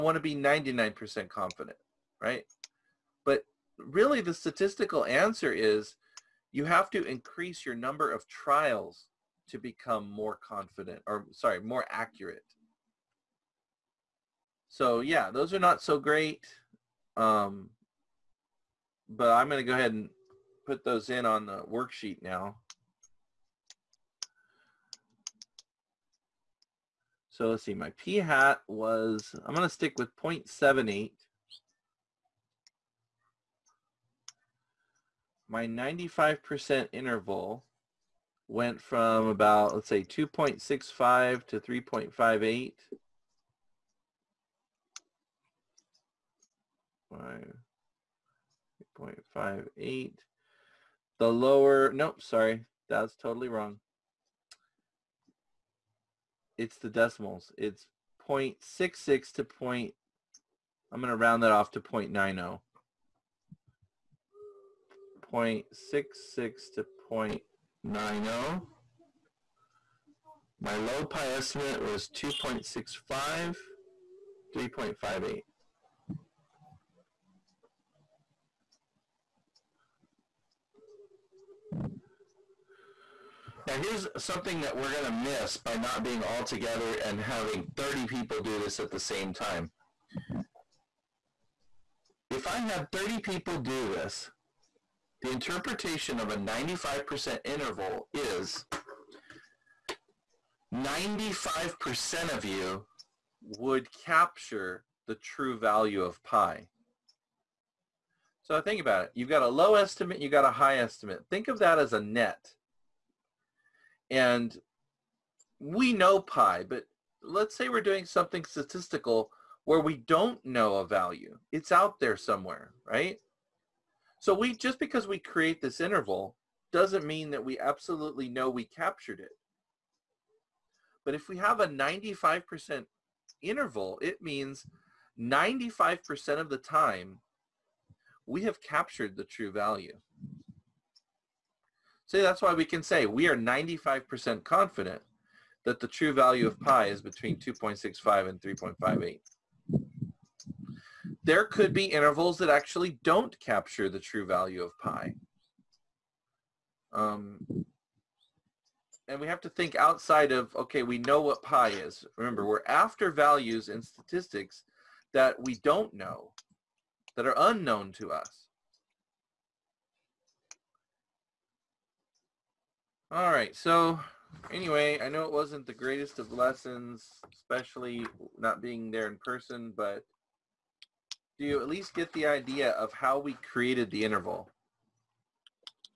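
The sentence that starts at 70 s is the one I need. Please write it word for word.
My low pi estimate was 2.65, 3.58.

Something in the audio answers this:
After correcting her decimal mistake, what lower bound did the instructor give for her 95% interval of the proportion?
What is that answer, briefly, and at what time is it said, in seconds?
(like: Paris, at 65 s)
0.66, at 57 s.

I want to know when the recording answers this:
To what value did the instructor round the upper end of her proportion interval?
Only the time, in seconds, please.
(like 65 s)
60 s.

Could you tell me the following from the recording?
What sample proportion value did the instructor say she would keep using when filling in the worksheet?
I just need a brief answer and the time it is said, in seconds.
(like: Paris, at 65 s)
0.78, at 30 s.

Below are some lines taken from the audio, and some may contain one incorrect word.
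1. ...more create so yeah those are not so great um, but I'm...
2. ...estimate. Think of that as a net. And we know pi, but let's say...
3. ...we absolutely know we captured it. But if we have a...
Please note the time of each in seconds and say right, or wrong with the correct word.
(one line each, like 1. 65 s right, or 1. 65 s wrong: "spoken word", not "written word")
1. 11 s wrong: "accurate", not "create"
2. 110 s right
3. 127 s right.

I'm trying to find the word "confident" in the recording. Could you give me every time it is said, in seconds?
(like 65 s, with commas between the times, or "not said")
1 s, 10 s, 144 s.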